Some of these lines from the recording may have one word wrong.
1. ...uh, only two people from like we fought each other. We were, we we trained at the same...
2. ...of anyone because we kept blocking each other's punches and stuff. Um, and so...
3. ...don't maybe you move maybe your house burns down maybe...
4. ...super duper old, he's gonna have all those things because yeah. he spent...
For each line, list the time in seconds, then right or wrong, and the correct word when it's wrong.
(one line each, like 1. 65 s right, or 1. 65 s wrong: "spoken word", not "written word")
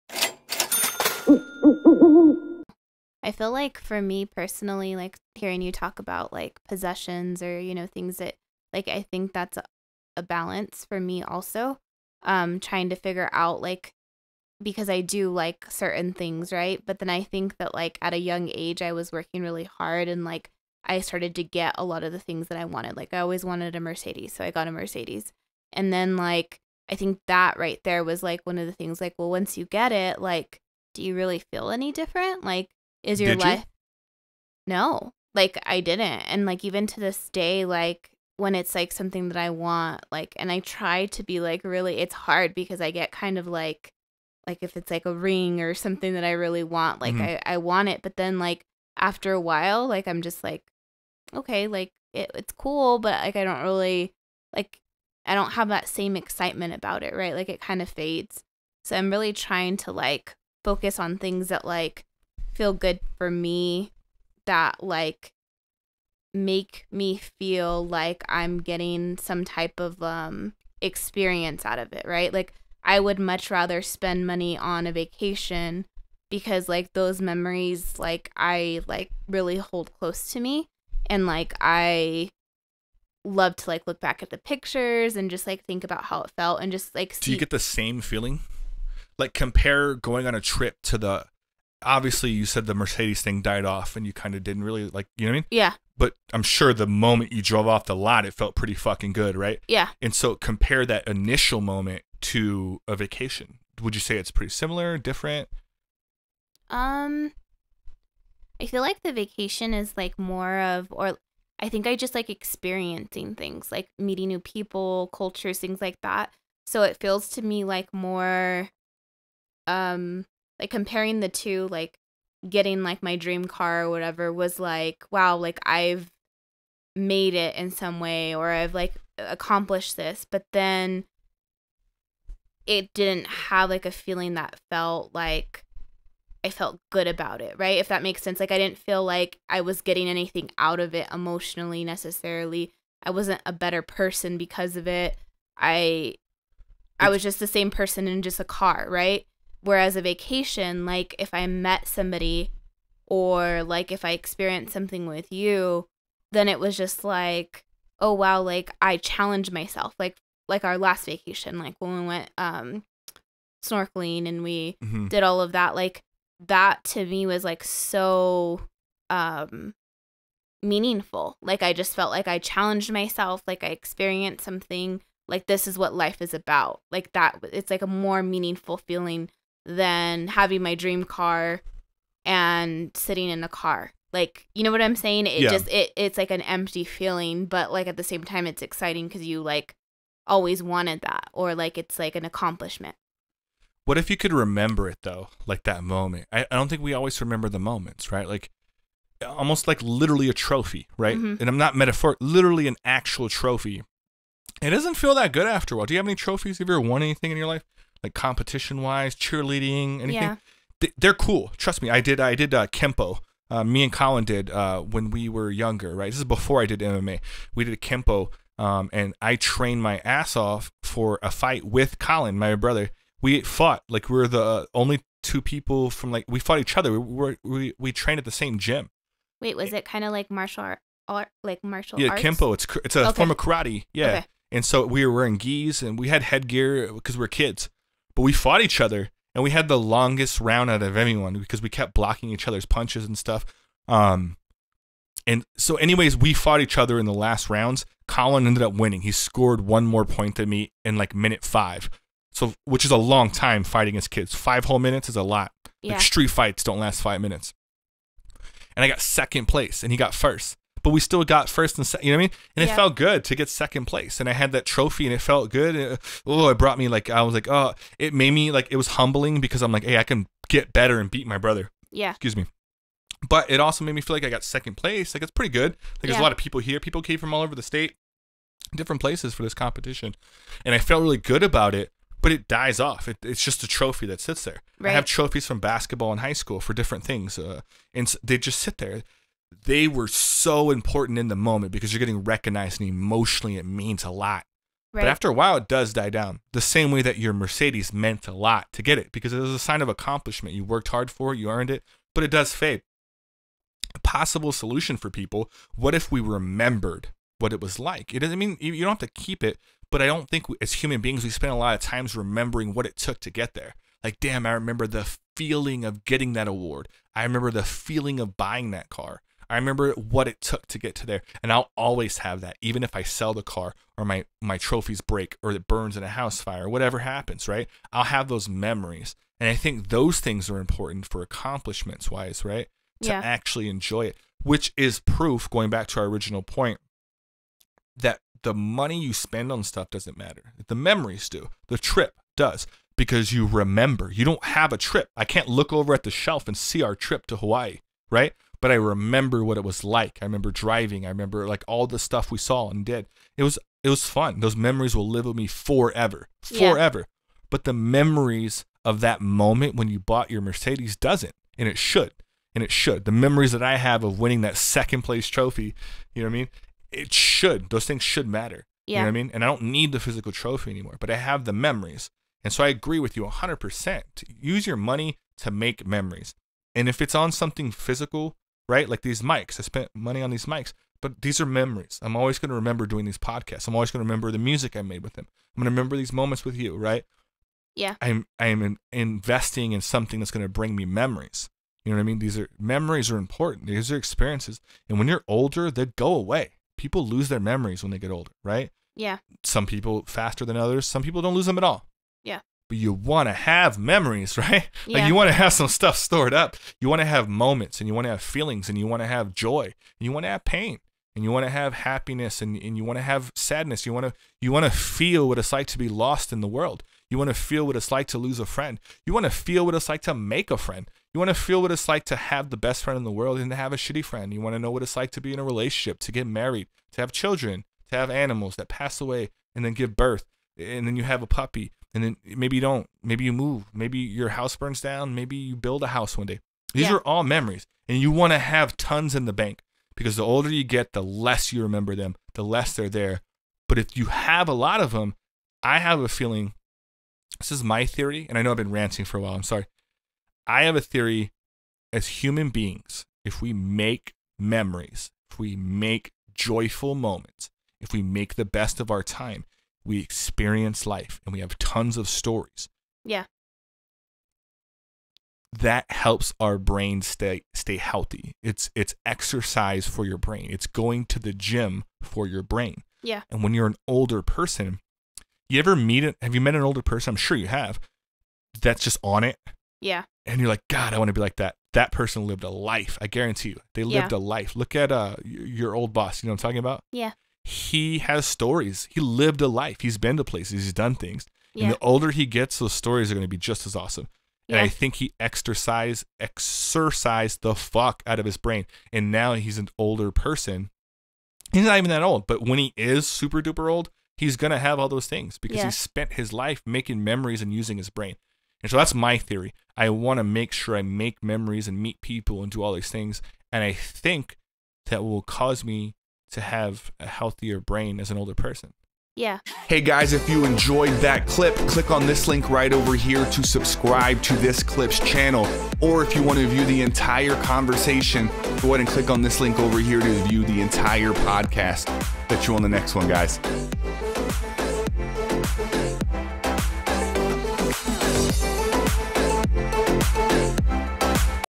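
1. 224 s right
2. 240 s right
3. 432 s right
4. 503 s right.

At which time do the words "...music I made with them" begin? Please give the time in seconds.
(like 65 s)
384 s.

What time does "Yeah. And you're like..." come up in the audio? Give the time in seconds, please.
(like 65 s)
479 s.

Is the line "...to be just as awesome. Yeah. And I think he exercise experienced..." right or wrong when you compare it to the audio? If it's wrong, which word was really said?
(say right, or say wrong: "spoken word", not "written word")
wrong: "exercised", not "experienced".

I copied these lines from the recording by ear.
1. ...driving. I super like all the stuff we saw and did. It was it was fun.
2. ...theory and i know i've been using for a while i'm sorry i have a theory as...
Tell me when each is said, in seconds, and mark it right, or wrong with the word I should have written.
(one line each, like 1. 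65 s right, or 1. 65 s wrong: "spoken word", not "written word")
1. 350 s wrong: "remember", not "super"
2. 447 s wrong: "ranting", not "using".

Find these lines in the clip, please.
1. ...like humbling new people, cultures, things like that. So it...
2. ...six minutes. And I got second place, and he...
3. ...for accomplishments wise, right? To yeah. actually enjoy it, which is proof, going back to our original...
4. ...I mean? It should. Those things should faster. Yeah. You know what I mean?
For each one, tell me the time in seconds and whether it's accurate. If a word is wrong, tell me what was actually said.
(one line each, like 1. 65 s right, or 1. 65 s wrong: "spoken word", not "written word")
1. 113 s wrong: "meeting", not "humbling"
2. 257 s wrong: "five", not "six"
3. 331 s right
4. 366 s wrong: "matter", not "faster".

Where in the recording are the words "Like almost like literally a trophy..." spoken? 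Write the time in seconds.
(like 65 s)
198 s.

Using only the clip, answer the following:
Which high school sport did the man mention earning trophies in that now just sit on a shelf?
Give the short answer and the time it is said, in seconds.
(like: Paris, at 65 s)
basketball, at 285 s.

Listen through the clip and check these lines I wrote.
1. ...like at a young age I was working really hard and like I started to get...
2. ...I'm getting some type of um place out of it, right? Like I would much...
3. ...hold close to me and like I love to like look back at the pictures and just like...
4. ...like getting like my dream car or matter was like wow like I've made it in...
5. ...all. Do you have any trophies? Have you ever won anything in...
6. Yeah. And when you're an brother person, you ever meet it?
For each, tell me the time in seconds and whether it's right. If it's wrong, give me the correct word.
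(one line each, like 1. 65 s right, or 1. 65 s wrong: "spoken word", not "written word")
1. 17 s right
2. 68 s wrong: "experience", not "place"
3. 79 s right
4. 121 s wrong: "whatever", not "matter"
5. 205 s right
6. 473 s wrong: "older", not "brother".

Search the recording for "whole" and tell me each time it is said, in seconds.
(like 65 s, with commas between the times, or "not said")
254 s.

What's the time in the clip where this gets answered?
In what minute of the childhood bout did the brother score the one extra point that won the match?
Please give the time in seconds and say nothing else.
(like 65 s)
251 s.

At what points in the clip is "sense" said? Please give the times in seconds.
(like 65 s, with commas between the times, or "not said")
138 s.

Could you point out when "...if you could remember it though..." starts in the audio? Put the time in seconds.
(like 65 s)
193 s.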